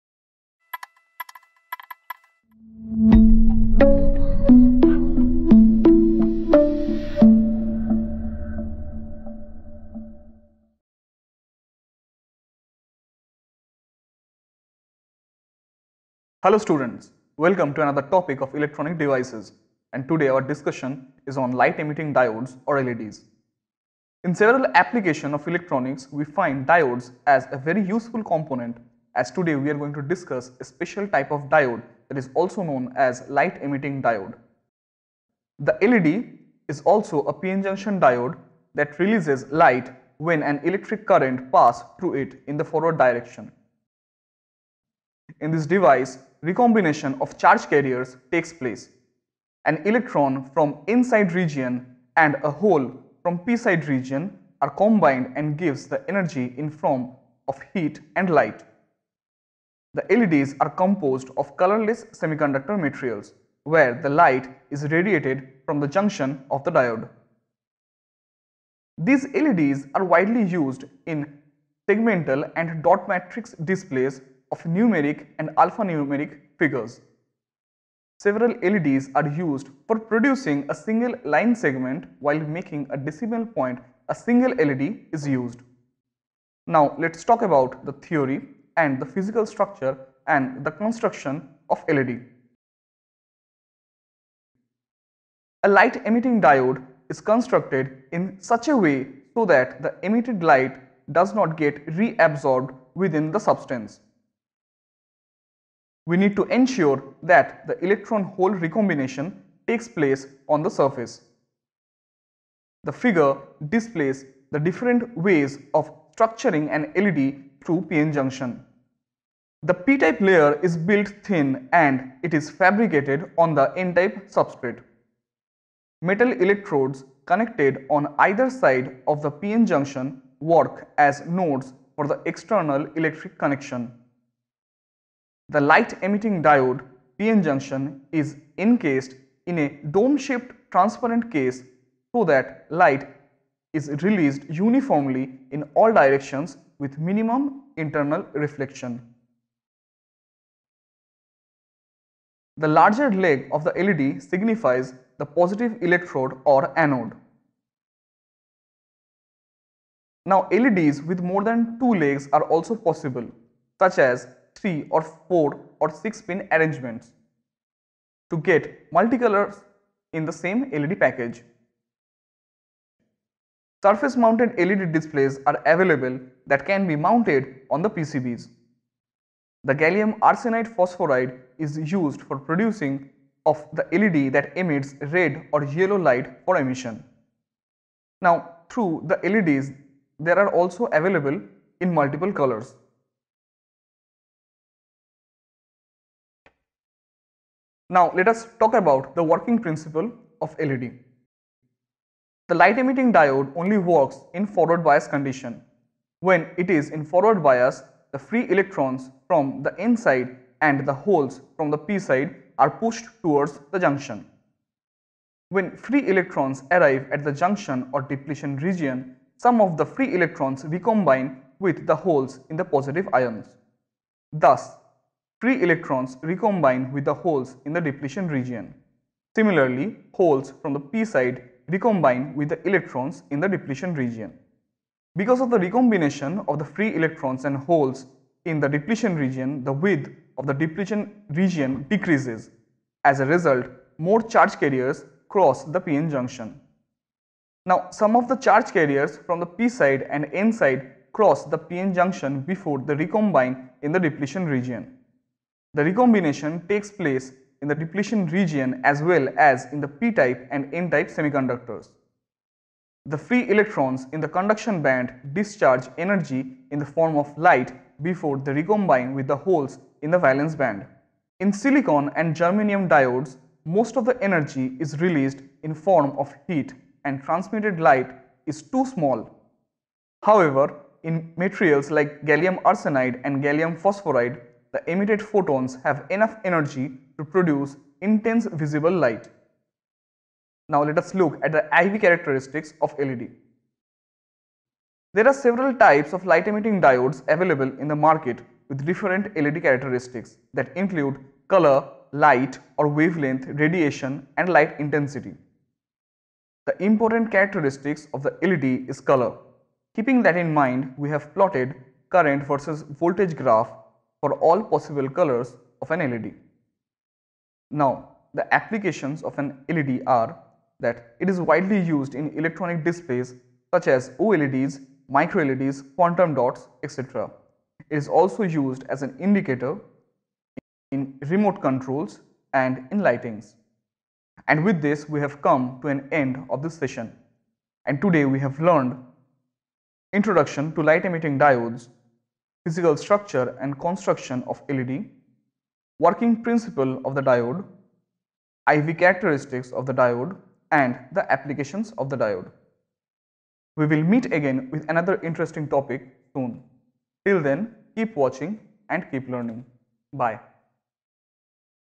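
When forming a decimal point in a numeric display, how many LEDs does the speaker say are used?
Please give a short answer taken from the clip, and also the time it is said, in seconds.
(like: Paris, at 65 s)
A single LED, at 84 s.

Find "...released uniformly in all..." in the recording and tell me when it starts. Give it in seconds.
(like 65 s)
144 s.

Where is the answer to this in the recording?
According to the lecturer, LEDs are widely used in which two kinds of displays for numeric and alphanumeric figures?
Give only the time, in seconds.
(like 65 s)
71 s.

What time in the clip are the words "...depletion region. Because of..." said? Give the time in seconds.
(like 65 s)
233 s.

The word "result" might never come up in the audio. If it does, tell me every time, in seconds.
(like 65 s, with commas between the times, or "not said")
243 s.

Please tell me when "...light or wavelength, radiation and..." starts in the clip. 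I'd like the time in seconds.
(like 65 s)
302 s.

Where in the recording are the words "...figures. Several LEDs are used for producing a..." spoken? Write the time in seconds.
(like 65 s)
76 s.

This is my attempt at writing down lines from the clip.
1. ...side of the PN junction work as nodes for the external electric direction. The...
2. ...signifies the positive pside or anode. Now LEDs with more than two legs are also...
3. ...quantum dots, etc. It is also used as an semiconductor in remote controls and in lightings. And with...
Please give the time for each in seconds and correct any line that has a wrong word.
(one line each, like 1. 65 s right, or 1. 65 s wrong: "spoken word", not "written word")
1. 128 s wrong: "connection", not "direction"
2. 154 s wrong: "electrode", not "pside"
3. 325 s wrong: "indicator", not "semiconductor".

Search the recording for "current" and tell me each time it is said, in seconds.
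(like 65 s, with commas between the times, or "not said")
41 s, 312 s.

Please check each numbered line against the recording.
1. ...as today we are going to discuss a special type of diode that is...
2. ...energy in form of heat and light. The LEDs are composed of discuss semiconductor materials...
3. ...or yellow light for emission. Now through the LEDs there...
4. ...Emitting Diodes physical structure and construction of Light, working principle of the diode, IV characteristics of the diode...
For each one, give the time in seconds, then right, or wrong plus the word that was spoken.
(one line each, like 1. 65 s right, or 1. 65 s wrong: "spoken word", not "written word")
1. 29 s right
2. 56 s wrong: "colorless", not "discuss"
3. 185 s right
4. 341 s wrong: "LED", not "Light".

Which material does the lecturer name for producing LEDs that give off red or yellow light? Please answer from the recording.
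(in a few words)
Gallium arsenide phosphoride.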